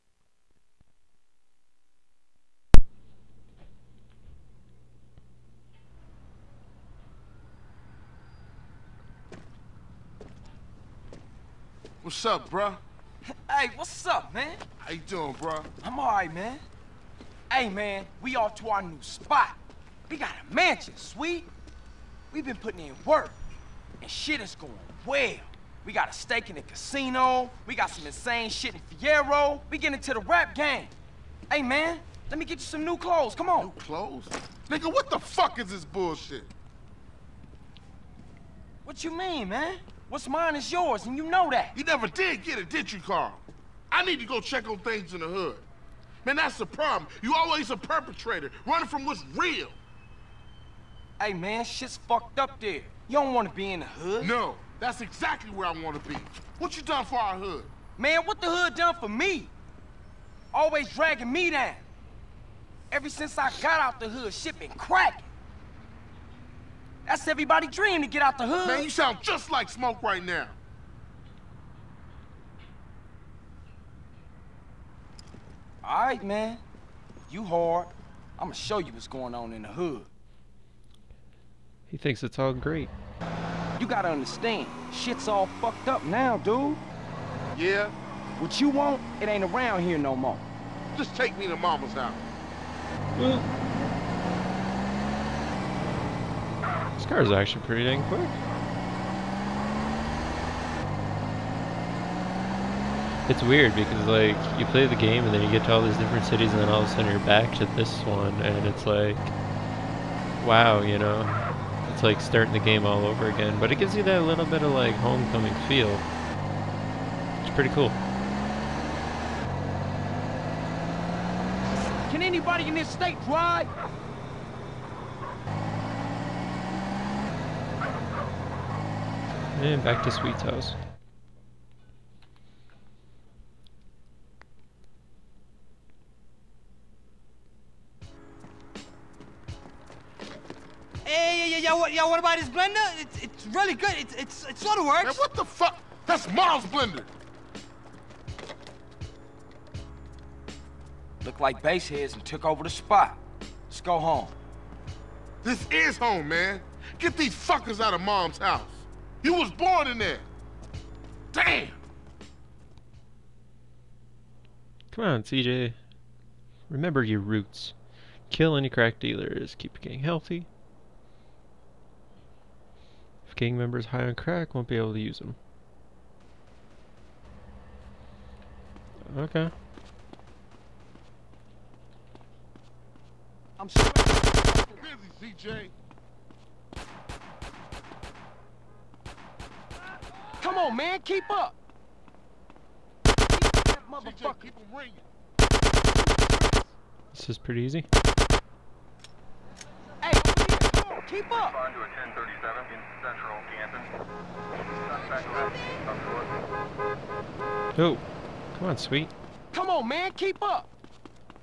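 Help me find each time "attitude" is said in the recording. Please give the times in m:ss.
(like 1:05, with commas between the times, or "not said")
not said.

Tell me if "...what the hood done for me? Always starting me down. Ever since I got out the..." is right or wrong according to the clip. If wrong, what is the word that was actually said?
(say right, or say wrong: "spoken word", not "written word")
wrong: "dragging", not "starting".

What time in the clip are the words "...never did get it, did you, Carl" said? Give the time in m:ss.
0:41.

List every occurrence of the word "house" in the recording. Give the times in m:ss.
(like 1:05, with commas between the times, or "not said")
1:31, 2:10, 2:38.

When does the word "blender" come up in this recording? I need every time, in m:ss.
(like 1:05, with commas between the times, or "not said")
2:22, 2:26.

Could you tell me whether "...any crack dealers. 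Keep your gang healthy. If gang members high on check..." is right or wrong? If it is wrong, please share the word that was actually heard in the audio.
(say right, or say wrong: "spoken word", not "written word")
wrong: "crack", not "check".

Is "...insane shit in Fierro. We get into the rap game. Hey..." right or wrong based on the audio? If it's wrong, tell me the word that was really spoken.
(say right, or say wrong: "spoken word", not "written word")
right.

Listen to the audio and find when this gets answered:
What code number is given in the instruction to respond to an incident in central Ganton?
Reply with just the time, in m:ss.
3:22.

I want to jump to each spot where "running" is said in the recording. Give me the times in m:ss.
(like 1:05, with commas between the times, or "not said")
0:48.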